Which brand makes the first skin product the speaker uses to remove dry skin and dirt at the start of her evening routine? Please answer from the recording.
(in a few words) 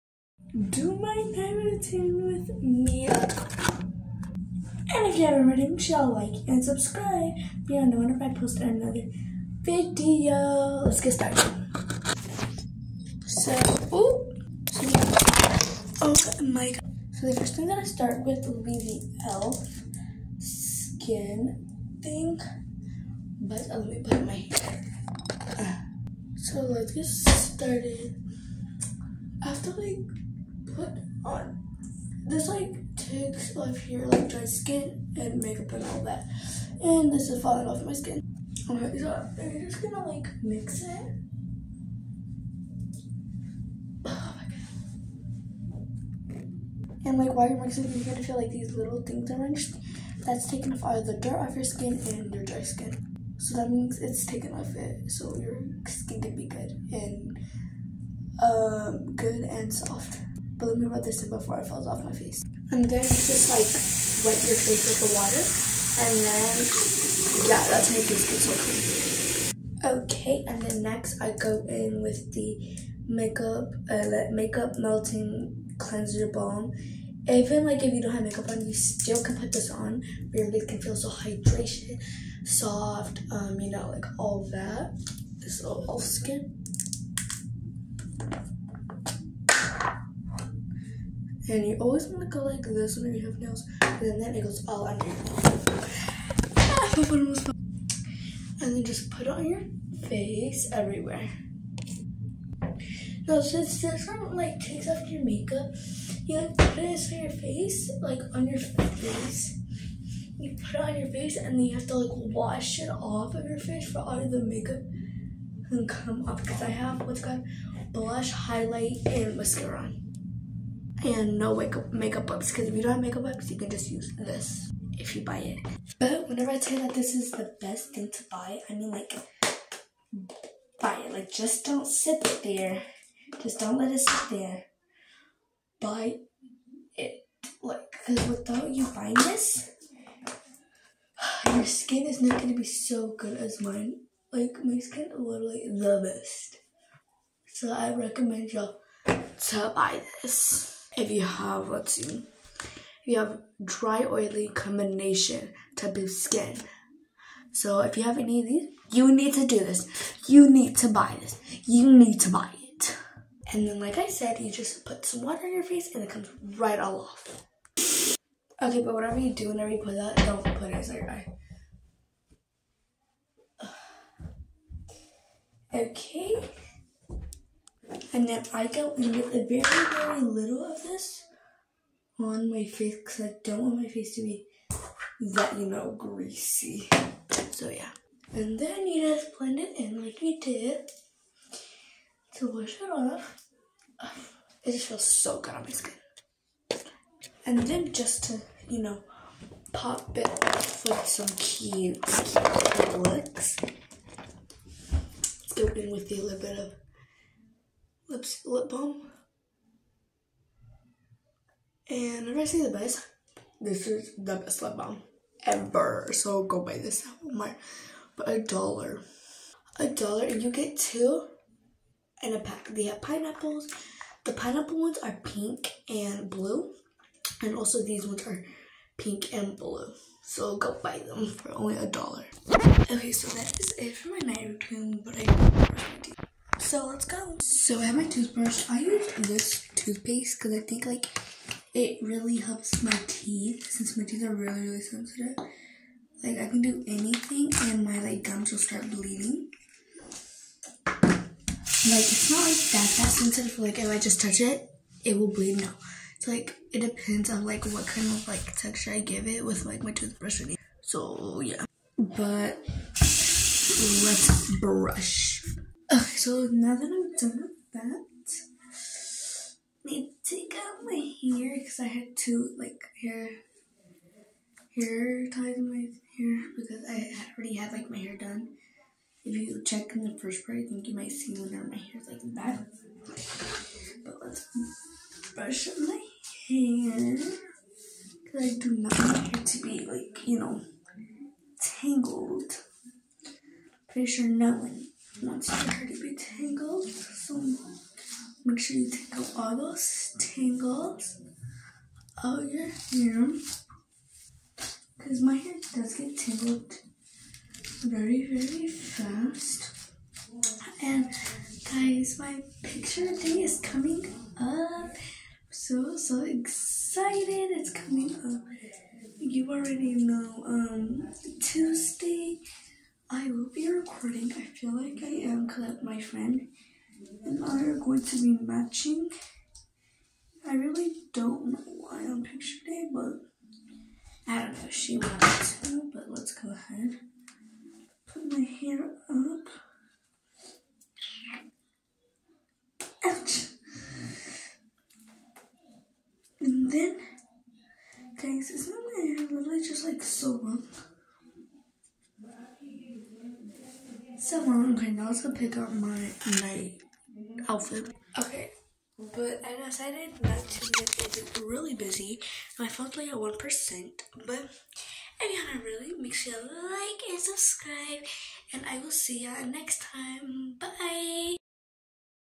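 Elf.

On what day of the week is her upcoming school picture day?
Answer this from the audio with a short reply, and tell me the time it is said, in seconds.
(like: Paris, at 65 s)
Tuesday, at 321 s.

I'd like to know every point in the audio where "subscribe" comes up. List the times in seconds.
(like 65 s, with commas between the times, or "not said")
6 s, 367 s.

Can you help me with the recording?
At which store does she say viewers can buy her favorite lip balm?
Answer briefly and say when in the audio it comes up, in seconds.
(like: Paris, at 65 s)
Walmart, at 217 s.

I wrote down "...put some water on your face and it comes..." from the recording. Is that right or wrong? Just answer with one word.
right.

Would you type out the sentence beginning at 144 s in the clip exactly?
Like, my skin is literally the best.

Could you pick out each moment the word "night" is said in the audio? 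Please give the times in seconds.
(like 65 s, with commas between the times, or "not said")
1 s, 234 s, 356 s.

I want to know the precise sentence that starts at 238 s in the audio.
I use this toothpaste because I think like it really helps my teeth since my teeth are really really sensitive.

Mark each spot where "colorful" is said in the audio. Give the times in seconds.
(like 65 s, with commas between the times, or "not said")
not said.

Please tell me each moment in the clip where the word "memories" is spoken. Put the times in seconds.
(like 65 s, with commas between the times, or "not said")
not said.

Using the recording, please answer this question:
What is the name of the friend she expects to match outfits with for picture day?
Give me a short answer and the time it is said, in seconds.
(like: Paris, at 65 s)
Colette, at 325 s.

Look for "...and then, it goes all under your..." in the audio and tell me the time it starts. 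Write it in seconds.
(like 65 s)
93 s.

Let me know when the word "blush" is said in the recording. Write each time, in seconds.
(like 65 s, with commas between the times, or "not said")
117 s.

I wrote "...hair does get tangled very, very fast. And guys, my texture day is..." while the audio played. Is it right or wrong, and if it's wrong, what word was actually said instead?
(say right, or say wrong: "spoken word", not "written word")
wrong: "picture", not "texture".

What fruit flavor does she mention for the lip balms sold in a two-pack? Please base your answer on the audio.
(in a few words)
Pineapple.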